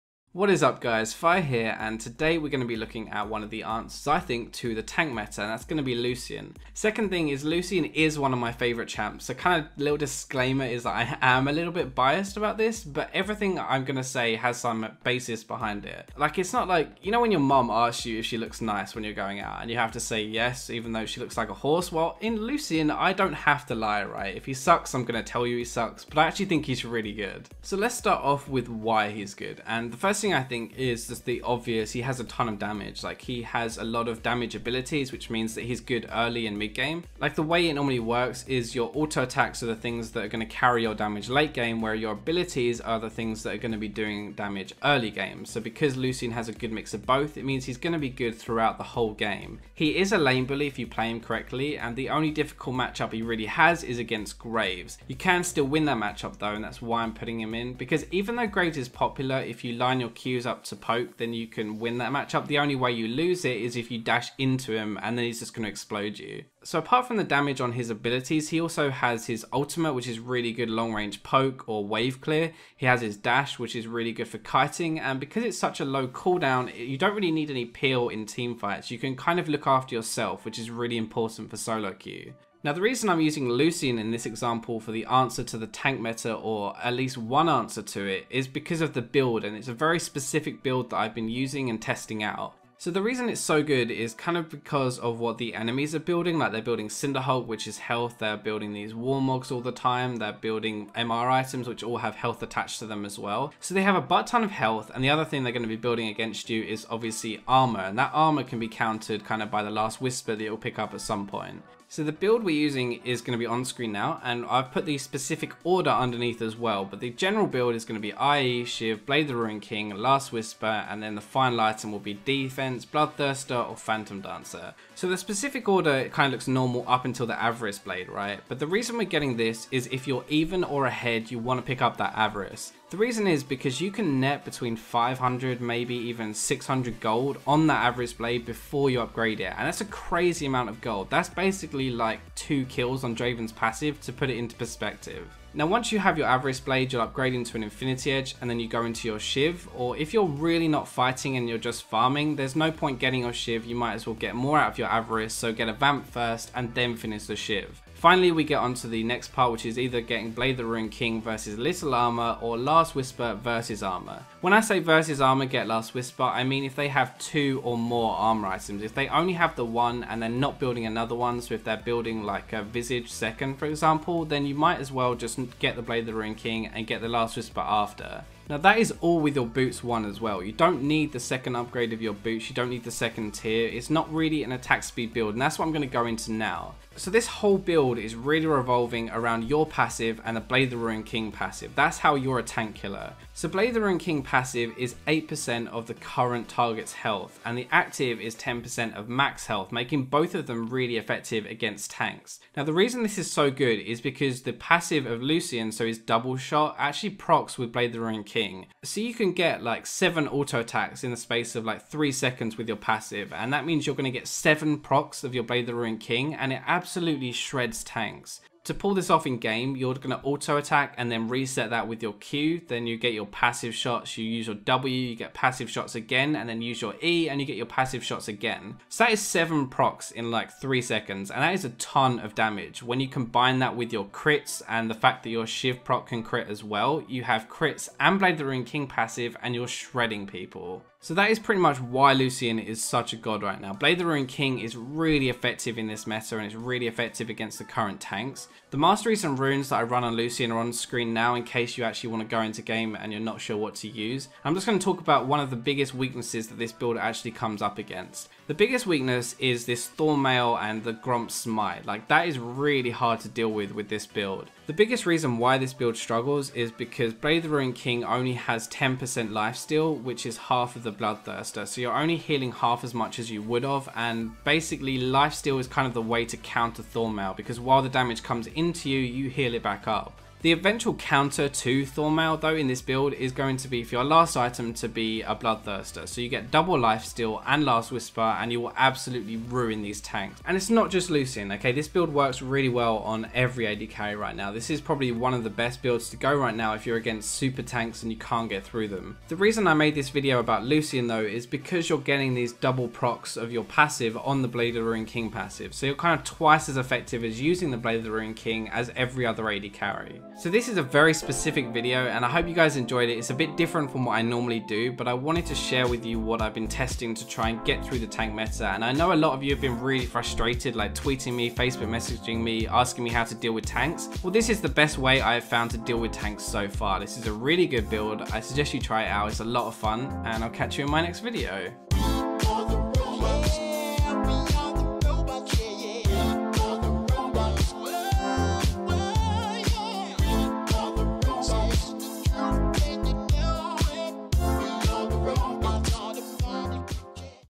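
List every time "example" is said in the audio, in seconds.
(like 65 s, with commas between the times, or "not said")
84 s, 173 s.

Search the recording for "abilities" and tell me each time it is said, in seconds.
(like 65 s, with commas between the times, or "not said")
34 s, 42 s, 67 s.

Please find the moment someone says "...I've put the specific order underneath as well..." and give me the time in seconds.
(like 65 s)
114 s.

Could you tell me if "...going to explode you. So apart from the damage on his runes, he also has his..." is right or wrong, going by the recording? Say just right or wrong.
wrong.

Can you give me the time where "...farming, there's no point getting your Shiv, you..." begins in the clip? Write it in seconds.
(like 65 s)
151 s.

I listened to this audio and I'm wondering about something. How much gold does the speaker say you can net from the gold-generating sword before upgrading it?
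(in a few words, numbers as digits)
600.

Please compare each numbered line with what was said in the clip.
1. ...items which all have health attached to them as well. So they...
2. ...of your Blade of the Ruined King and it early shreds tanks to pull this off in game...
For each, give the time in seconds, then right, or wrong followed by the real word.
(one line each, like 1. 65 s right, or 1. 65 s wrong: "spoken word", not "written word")
1. 101 s right
2. 215 s wrong: "absolutely", not "early".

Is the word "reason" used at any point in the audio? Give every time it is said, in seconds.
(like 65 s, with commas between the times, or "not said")
82 s, 93 s, 128 s, 132 s, 202 s, 265 s, 299 s.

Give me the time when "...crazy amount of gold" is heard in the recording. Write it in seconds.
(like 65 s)
139 s.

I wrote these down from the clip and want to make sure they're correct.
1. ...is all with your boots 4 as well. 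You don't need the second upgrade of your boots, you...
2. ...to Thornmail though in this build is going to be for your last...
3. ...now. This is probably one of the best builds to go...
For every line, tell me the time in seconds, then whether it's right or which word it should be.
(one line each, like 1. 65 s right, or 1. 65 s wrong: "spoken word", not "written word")
1. 178 s wrong: "1", not "4"
2. 281 s right
3. 294 s right.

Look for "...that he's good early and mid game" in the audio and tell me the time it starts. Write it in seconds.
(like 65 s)
35 s.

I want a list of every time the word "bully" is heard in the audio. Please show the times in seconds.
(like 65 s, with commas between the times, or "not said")
50 s.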